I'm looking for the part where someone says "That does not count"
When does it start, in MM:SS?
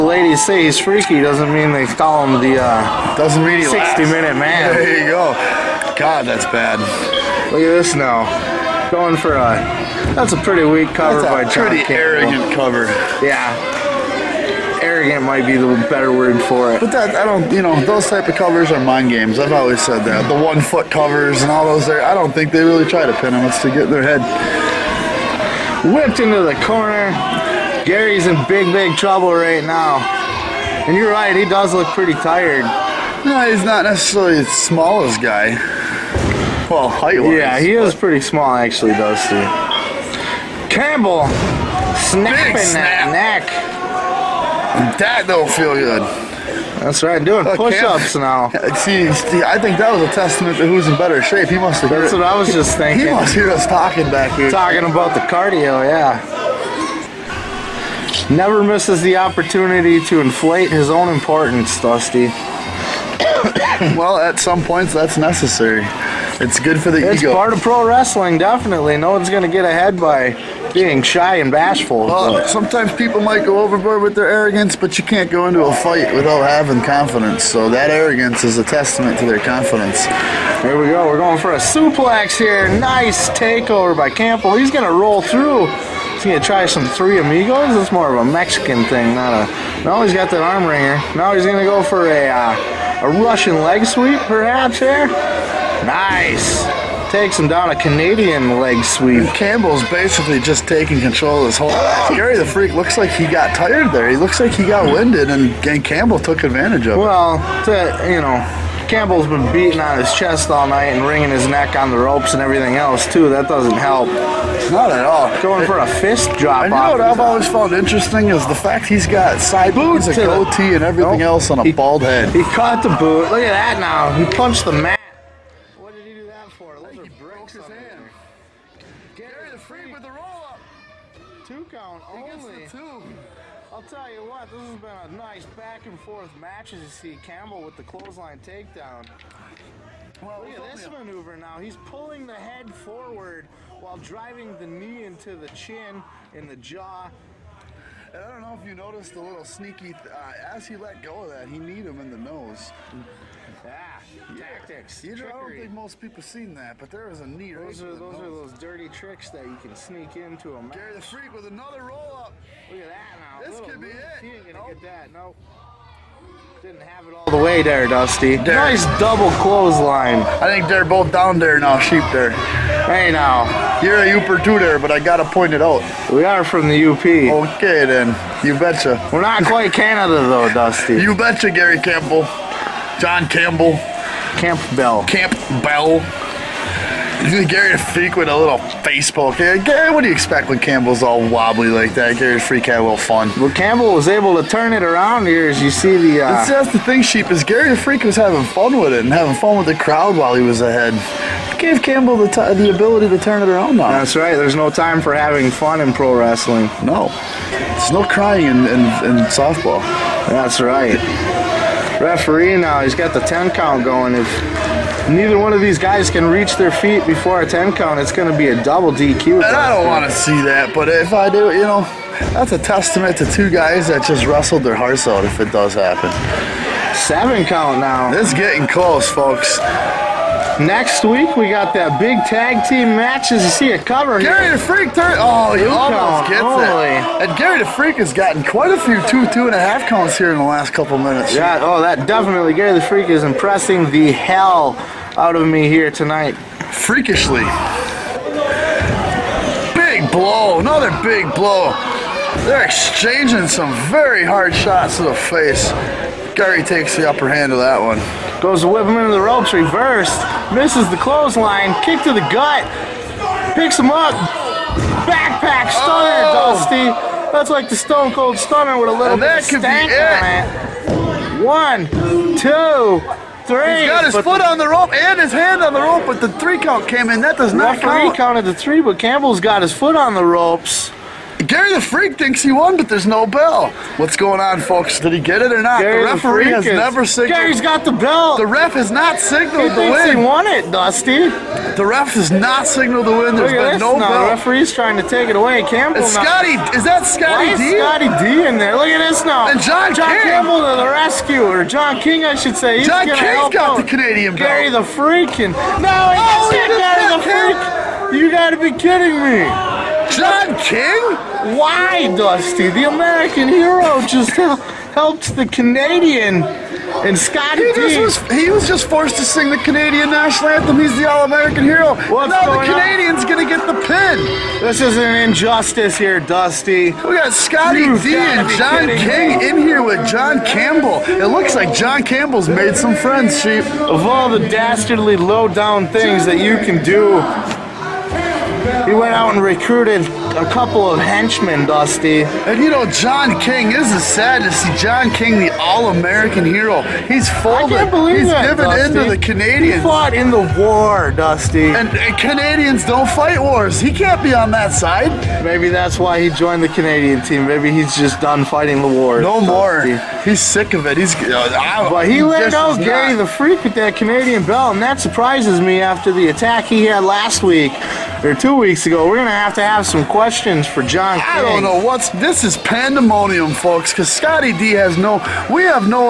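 04:37.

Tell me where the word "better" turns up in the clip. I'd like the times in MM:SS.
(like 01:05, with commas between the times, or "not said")
00:15, 00:50.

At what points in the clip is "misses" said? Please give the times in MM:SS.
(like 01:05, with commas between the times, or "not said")
00:58, 04:20.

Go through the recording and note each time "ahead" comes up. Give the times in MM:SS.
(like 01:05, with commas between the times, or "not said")
01:09, 03:20.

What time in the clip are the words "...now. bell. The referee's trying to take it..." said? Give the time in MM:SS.
04:53.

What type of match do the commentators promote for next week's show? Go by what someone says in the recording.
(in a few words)
tag team match.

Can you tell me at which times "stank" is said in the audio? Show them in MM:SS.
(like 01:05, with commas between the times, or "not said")
04:29.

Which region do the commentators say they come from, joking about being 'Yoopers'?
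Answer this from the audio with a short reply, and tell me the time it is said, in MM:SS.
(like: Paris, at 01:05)
the UP, at 02:56.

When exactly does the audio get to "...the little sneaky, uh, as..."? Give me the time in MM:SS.
02:29.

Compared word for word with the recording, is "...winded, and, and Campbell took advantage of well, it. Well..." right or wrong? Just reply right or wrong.
right.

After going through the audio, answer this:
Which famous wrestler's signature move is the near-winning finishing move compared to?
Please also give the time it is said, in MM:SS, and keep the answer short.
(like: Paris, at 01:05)
Stone Cold Stunner, at 04:27.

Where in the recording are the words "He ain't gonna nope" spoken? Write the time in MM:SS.
02:44.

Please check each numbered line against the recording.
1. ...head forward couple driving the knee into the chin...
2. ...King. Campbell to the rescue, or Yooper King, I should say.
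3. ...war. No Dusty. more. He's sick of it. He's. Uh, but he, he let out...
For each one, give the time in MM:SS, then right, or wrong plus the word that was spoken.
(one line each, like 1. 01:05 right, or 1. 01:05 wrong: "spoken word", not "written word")
1. 02:22 wrong: "while", not "couple"
2. 05:00 wrong: "John", not "Yooper"
3. 05:58 right.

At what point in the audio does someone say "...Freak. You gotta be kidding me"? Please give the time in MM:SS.
05:07.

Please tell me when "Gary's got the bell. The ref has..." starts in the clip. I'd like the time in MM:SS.
04:47.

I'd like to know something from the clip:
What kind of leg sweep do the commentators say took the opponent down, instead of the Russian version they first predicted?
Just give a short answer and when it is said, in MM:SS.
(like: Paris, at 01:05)
Canadian leg sweep, at 01:37.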